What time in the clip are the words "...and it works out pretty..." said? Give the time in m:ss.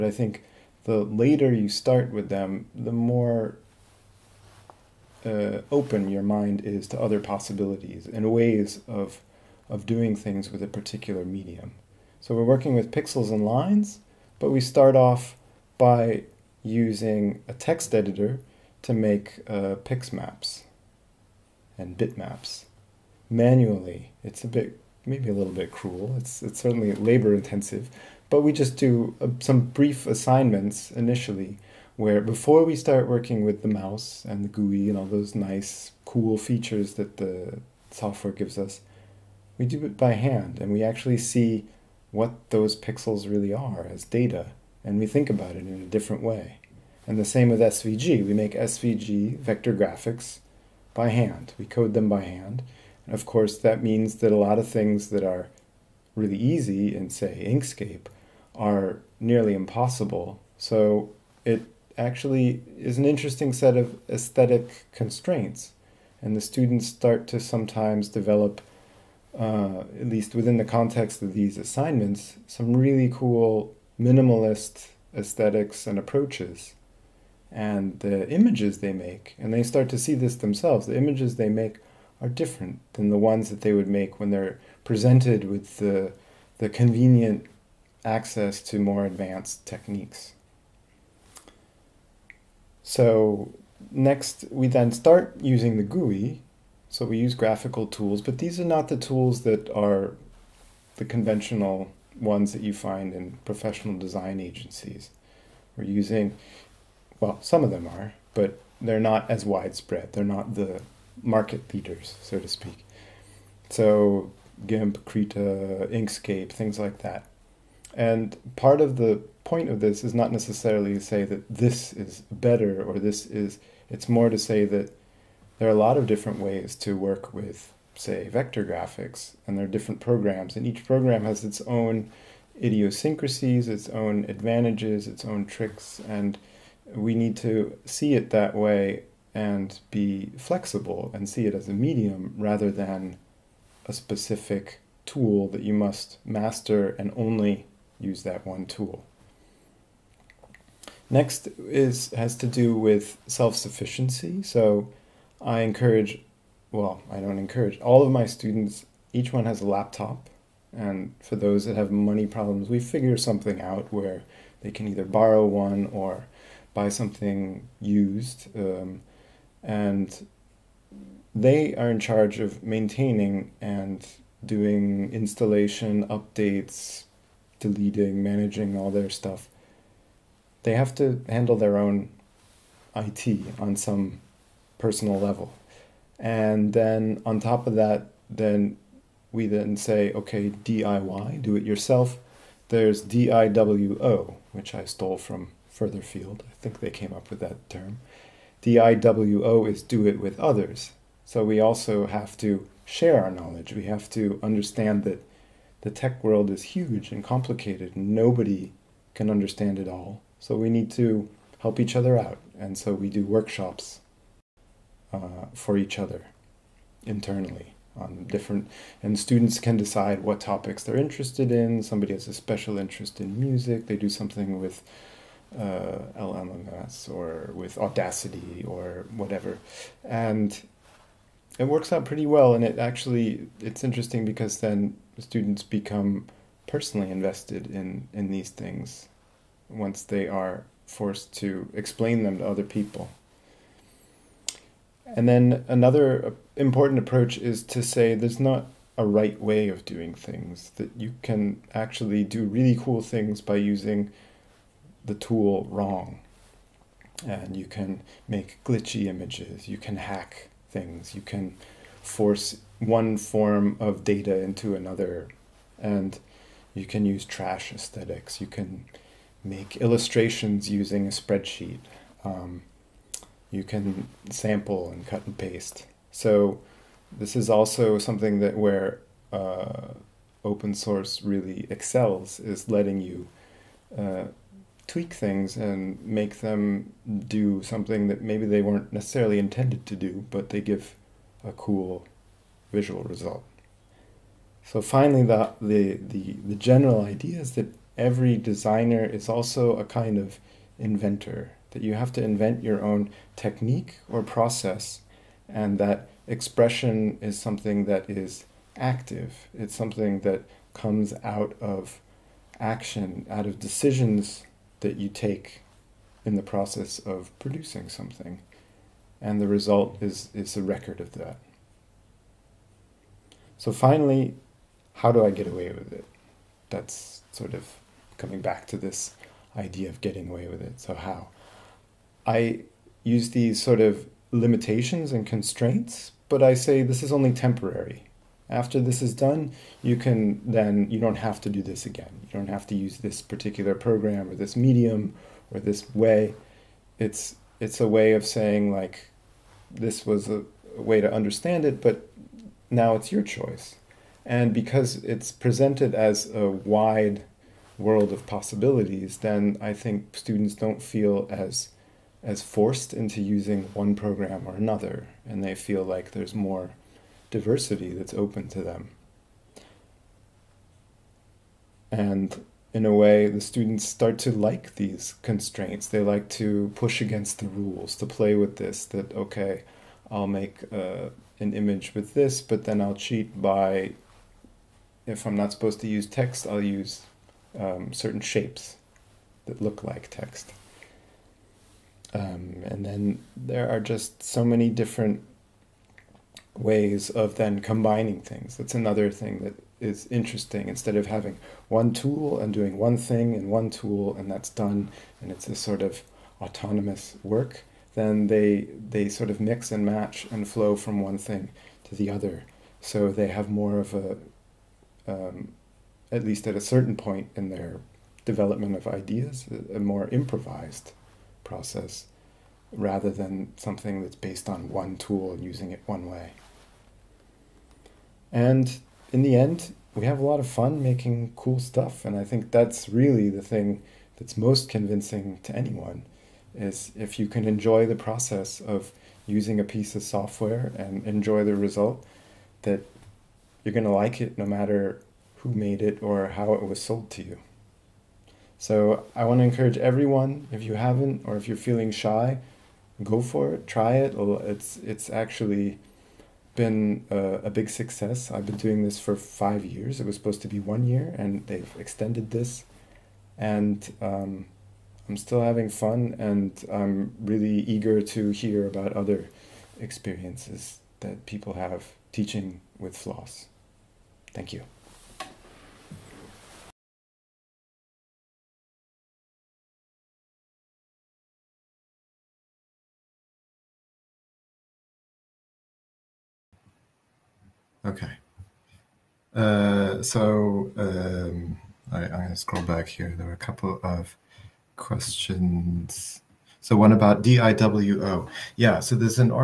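3:50.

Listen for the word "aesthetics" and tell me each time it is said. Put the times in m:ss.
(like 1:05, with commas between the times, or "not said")
1:04, 1:15, 4:27.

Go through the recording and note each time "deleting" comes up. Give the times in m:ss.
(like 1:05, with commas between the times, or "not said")
2:57.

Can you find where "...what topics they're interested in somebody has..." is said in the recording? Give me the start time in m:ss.
3:40.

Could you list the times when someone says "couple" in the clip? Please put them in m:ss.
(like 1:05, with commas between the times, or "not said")
8:13.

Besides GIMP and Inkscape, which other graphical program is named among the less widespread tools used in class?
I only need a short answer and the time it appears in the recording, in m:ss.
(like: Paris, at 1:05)
Krita, at 1:55.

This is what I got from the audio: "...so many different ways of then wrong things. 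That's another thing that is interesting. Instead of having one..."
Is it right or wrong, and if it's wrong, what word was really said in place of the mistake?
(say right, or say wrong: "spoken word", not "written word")
wrong: "combining", not "wrong".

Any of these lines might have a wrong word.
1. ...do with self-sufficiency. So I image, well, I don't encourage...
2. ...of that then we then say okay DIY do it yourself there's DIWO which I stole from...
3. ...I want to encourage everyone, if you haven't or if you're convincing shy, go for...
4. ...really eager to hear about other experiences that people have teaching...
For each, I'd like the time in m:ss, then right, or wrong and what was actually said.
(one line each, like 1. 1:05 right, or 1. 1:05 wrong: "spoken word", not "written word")
1. 2:32 wrong: "encourage", not "image"
2. 3:07 right
3. 7:29 wrong: "feeling", not "convincing"
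4. 7:47 right.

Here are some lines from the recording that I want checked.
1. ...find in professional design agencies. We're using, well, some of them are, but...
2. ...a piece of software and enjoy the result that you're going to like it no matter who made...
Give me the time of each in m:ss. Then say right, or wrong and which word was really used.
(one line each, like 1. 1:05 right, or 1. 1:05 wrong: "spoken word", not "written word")
1. 1:42 right
2. 7:19 right.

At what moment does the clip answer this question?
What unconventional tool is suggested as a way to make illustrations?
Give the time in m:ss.
4:30.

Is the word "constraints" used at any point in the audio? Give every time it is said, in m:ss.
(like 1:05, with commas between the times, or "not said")
1:04, 5:35, 6:15.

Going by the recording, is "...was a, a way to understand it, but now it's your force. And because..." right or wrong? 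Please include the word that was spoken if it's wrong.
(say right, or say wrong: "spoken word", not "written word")
wrong: "choice", not "force".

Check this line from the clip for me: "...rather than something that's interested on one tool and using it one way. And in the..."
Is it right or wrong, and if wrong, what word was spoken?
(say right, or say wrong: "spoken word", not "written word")
wrong: "based", not "interested".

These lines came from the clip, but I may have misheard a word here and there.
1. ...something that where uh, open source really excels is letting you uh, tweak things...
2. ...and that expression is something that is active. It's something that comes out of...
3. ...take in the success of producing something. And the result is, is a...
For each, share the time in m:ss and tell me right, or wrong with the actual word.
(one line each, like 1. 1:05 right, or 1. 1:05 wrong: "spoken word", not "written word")
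1. 4:37 right
2. 5:05 right
3. 5:15 wrong: "process", not "success".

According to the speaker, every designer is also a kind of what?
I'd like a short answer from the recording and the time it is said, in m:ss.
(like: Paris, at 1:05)
inventor, at 5:00.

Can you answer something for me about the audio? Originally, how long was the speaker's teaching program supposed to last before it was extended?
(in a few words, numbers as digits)
1 year.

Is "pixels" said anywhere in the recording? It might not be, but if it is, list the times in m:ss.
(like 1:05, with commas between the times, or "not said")
0:12, 0:42.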